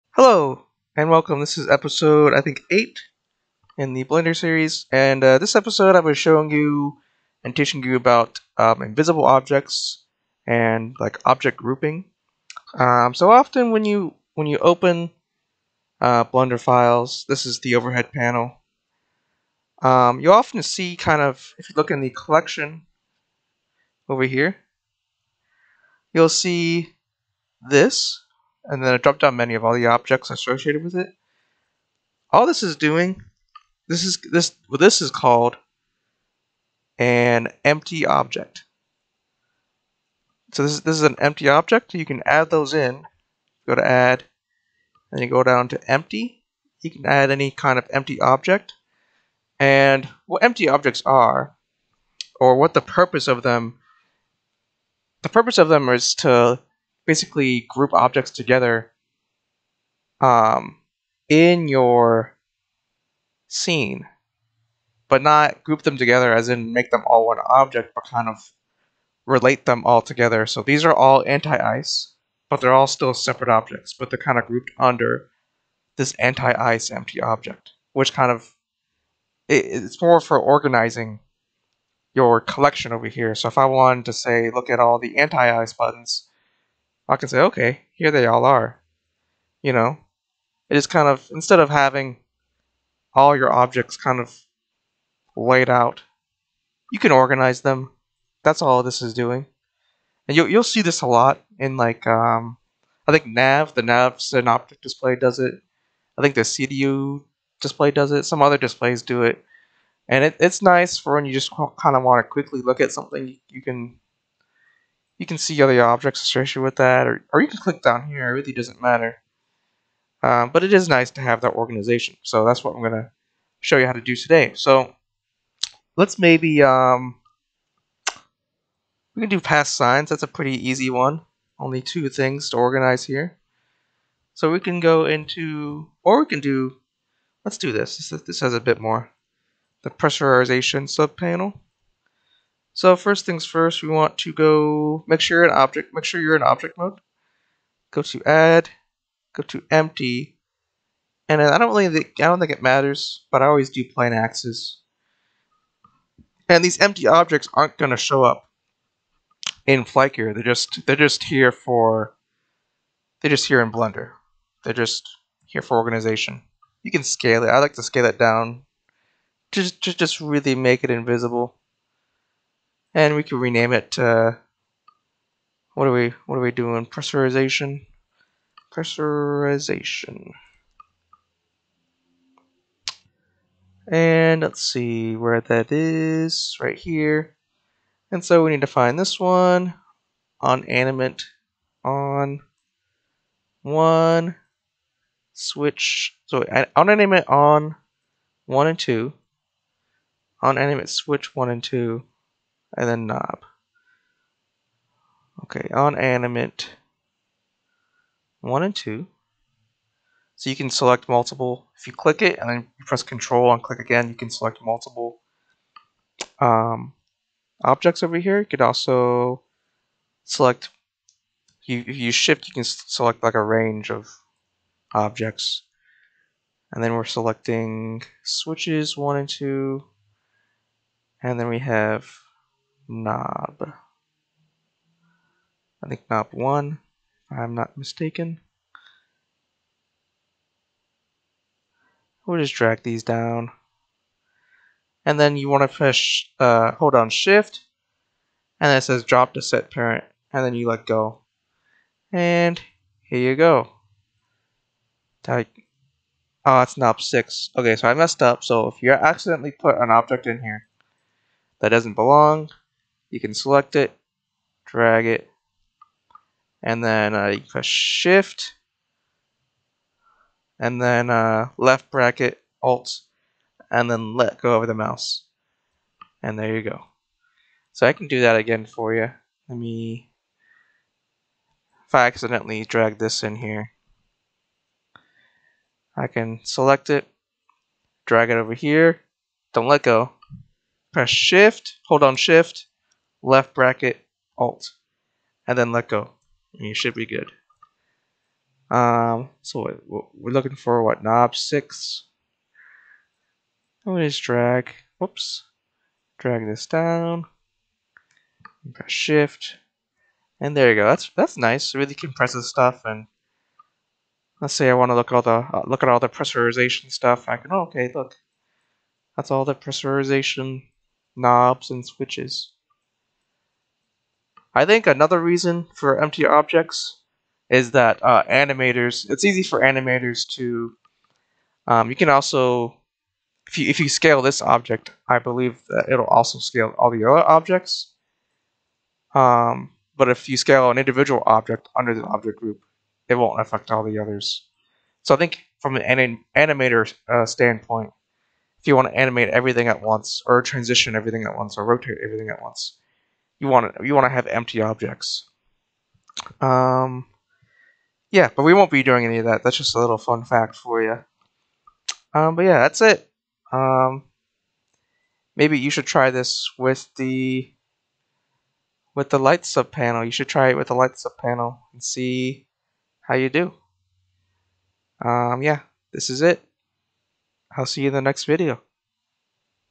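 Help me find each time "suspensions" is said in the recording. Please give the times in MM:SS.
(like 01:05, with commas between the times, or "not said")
not said.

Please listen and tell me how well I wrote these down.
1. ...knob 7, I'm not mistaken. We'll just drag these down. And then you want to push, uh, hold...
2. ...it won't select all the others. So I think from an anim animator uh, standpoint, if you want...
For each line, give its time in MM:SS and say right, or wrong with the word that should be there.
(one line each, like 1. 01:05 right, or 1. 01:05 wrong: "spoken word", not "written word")
1. 03:56 wrong: "1", not "7"
2. 05:43 wrong: "affect", not "select".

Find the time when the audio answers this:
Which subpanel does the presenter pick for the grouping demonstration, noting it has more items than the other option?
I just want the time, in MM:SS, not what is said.
02:19.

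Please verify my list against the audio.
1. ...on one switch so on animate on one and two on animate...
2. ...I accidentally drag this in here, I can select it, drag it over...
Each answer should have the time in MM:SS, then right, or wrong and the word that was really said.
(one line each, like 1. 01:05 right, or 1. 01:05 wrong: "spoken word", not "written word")
1. 03:11 right
2. 04:41 right.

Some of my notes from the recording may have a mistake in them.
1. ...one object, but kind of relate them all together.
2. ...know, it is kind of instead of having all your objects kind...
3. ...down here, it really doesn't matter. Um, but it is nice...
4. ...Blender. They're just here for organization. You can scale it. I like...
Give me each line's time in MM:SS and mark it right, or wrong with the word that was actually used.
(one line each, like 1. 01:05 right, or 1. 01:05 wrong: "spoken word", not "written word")
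1. 01:07 right
2. 01:29 right
3. 01:57 right
4. 02:43 right.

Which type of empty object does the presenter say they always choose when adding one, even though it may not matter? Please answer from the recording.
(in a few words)
Plane axes.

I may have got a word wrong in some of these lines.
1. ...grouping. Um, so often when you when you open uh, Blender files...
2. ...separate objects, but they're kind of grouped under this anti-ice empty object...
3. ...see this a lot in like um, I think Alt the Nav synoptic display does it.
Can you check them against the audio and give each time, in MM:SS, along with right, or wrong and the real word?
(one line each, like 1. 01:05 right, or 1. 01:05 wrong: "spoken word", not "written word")
1. 00:11 right
2. 01:13 right
3. 01:40 wrong: "Nav", not "Alt".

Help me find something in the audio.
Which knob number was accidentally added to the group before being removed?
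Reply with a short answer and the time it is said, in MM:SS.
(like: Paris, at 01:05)
6, at 04:16.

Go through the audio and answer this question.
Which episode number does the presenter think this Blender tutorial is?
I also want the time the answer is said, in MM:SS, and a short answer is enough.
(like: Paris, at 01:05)
8, at 00:02.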